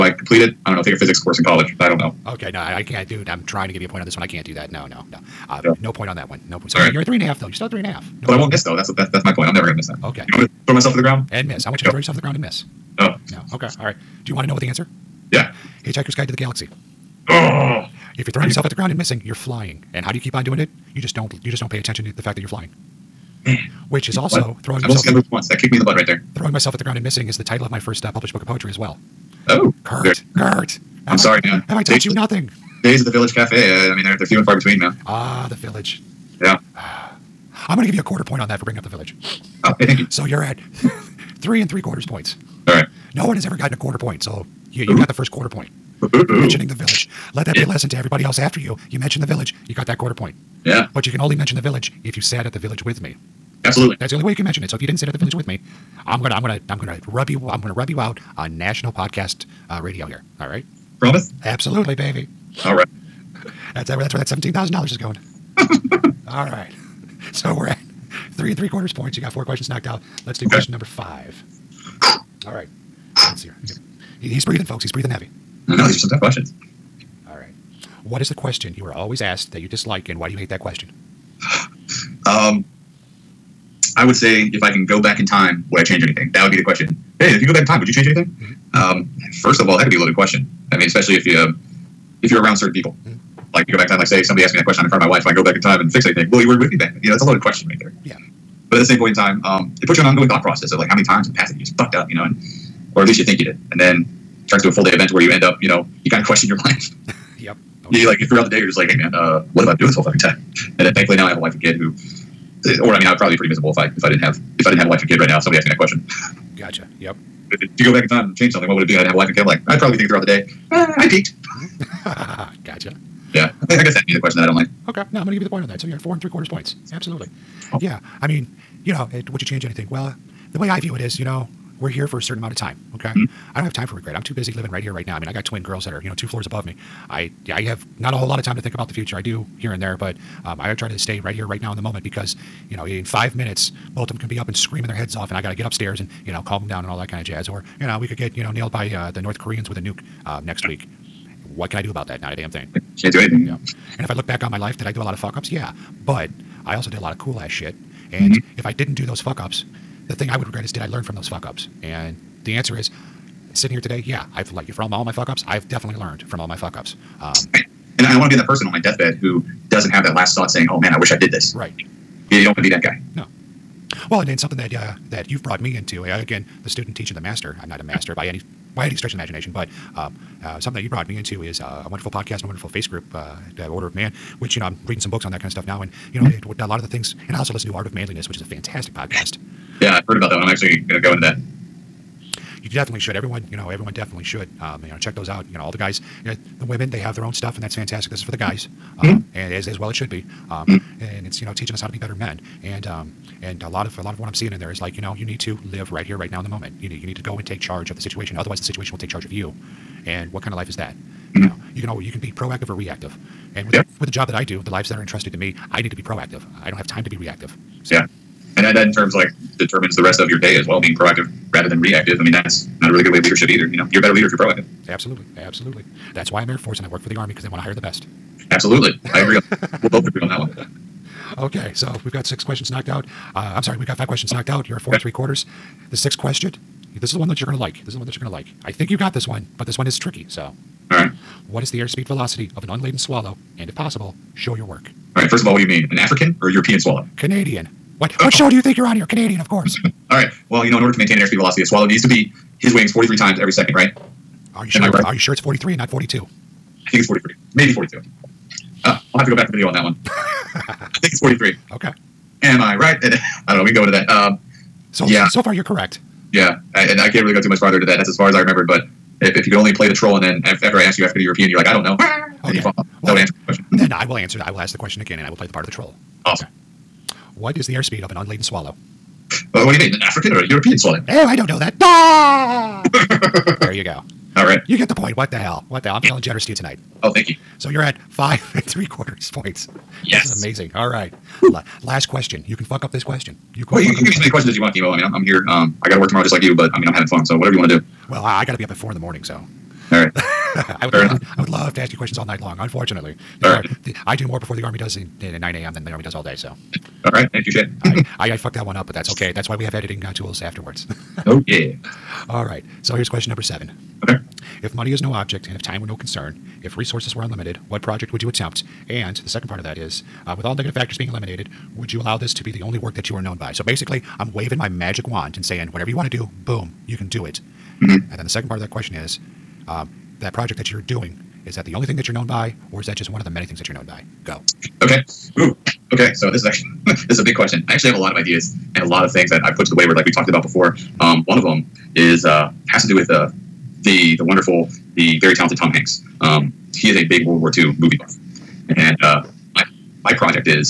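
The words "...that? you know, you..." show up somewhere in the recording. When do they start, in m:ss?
3:30.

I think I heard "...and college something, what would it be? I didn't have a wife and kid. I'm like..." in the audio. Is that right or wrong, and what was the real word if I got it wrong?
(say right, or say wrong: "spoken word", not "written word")
wrong: "change", not "college".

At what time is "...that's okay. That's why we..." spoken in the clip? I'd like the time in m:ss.
5:08.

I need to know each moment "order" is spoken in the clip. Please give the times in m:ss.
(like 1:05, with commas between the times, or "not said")
3:03, 4:10.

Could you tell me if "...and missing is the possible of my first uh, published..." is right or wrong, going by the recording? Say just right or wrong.
wrong.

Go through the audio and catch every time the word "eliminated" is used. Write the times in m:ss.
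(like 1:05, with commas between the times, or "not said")
5:21.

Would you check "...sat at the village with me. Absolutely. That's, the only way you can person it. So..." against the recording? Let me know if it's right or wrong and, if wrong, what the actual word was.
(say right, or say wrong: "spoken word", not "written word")
wrong: "mention", not "person".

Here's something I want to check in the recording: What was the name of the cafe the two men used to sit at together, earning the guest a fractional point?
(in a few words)
Village Cafe.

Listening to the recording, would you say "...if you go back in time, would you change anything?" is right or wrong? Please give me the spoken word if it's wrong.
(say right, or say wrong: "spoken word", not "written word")
right.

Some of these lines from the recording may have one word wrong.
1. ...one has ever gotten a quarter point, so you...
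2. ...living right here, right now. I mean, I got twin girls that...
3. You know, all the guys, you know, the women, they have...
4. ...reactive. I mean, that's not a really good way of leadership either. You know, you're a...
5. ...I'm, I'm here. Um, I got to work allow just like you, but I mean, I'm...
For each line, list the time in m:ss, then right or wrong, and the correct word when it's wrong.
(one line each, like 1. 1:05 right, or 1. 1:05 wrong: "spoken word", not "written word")
1. 0:43 right
2. 2:14 right
3. 3:15 right
4. 3:41 right
5. 4:55 wrong: "tomorrow", not "allow".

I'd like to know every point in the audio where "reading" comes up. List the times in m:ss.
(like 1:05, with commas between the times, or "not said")
3:04.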